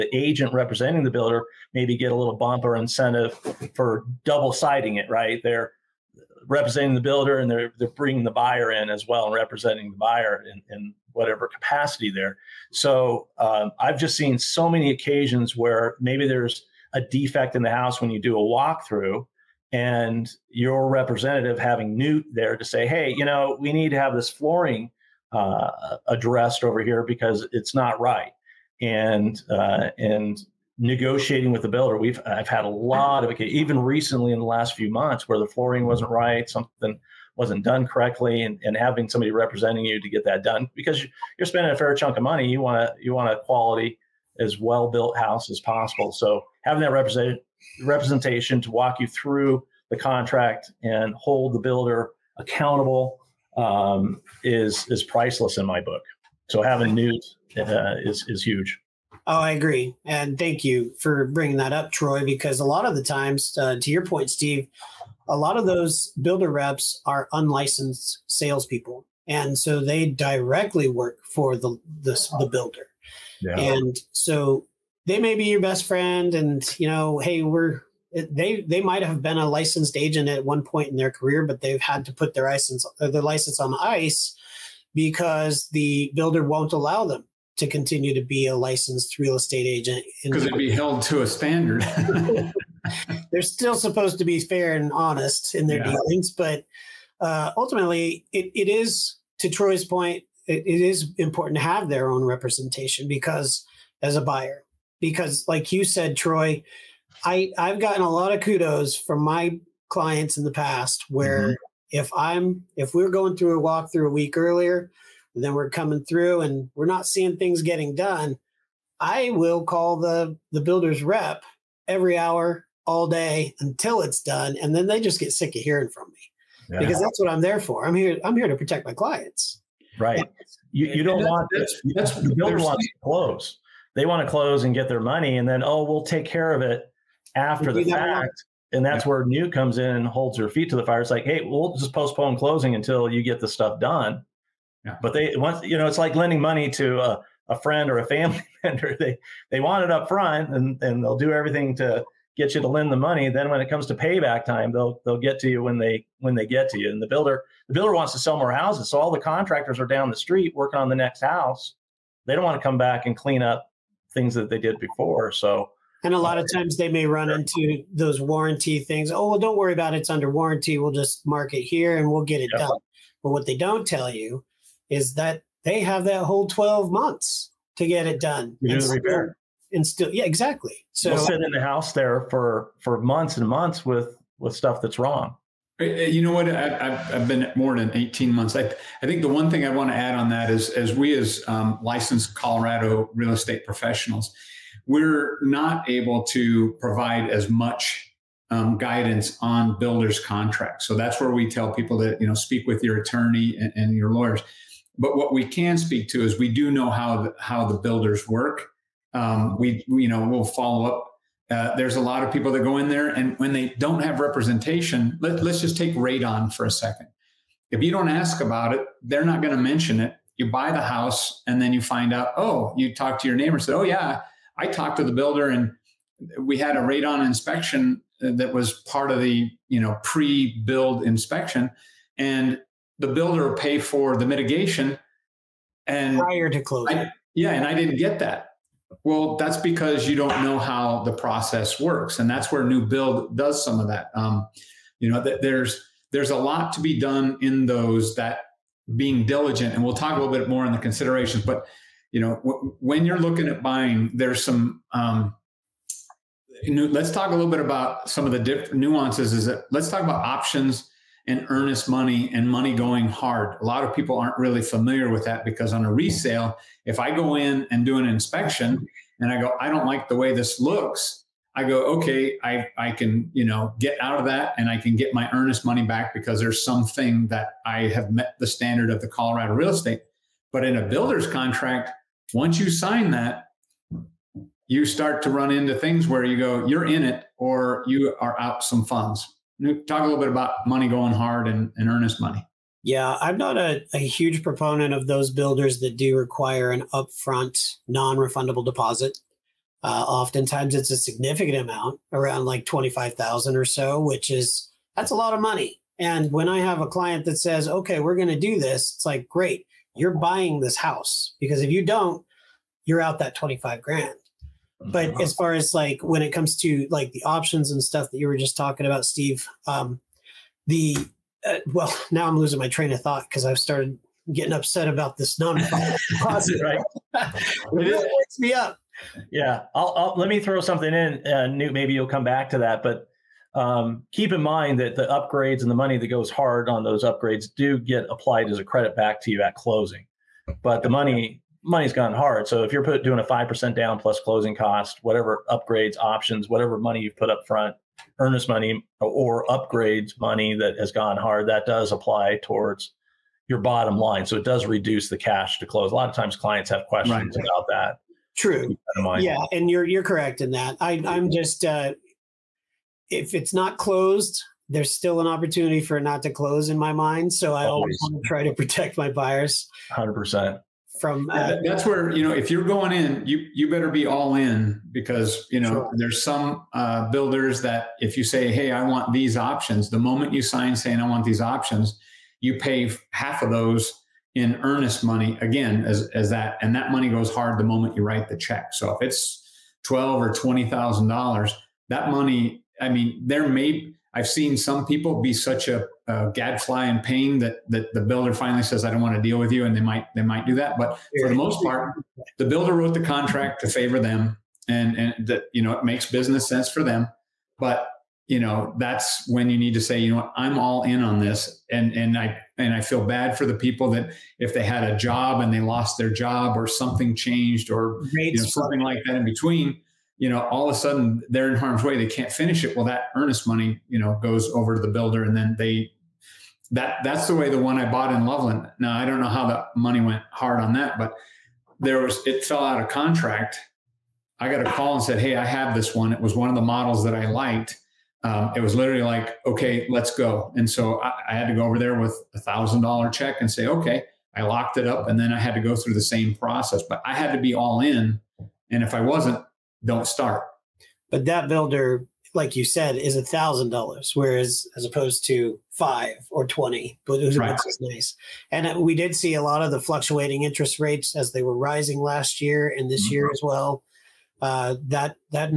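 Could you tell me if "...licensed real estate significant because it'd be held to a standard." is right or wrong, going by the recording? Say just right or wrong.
wrong.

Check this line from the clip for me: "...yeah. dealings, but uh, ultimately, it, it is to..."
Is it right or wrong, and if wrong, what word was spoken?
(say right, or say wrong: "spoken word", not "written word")
right.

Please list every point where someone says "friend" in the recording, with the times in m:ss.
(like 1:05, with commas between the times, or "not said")
1:15, 2:27.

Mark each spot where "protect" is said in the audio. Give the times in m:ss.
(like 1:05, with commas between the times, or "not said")
2:08, 6:08.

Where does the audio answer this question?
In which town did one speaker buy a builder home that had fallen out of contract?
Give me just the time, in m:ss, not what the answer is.
7:08.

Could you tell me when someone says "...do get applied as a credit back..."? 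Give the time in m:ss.
5:37.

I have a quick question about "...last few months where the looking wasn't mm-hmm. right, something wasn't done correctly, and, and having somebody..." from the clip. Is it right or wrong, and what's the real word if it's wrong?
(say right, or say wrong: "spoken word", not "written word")
wrong: "flooring", not "looking".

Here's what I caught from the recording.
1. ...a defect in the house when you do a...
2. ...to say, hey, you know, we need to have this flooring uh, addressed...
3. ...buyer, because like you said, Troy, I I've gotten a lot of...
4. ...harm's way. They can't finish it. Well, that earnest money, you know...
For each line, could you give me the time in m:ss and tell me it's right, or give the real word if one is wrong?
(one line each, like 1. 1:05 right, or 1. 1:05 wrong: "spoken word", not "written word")
1. 0:16 right
2. 0:22 right
3. 1:44 right
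4. 7:01 right.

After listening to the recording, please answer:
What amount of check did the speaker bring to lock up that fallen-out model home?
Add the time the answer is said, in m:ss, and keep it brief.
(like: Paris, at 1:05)
$1,000, at 7:22.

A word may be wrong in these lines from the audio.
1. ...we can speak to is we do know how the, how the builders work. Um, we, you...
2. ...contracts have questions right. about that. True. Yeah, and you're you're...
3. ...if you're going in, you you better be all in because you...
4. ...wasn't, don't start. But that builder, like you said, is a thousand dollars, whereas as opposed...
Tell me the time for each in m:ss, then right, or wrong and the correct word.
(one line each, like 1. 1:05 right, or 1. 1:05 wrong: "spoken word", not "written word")
1. 3:25 right
2. 5:56 wrong: "clients", not "contracts"
3. 6:12 right
4. 7:29 right.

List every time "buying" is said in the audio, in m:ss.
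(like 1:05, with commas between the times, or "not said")
4:13, 5:10.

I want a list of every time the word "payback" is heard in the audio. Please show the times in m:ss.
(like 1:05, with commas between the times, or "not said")
2:33.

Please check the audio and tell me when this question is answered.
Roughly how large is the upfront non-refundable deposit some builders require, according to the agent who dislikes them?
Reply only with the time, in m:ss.
5:02.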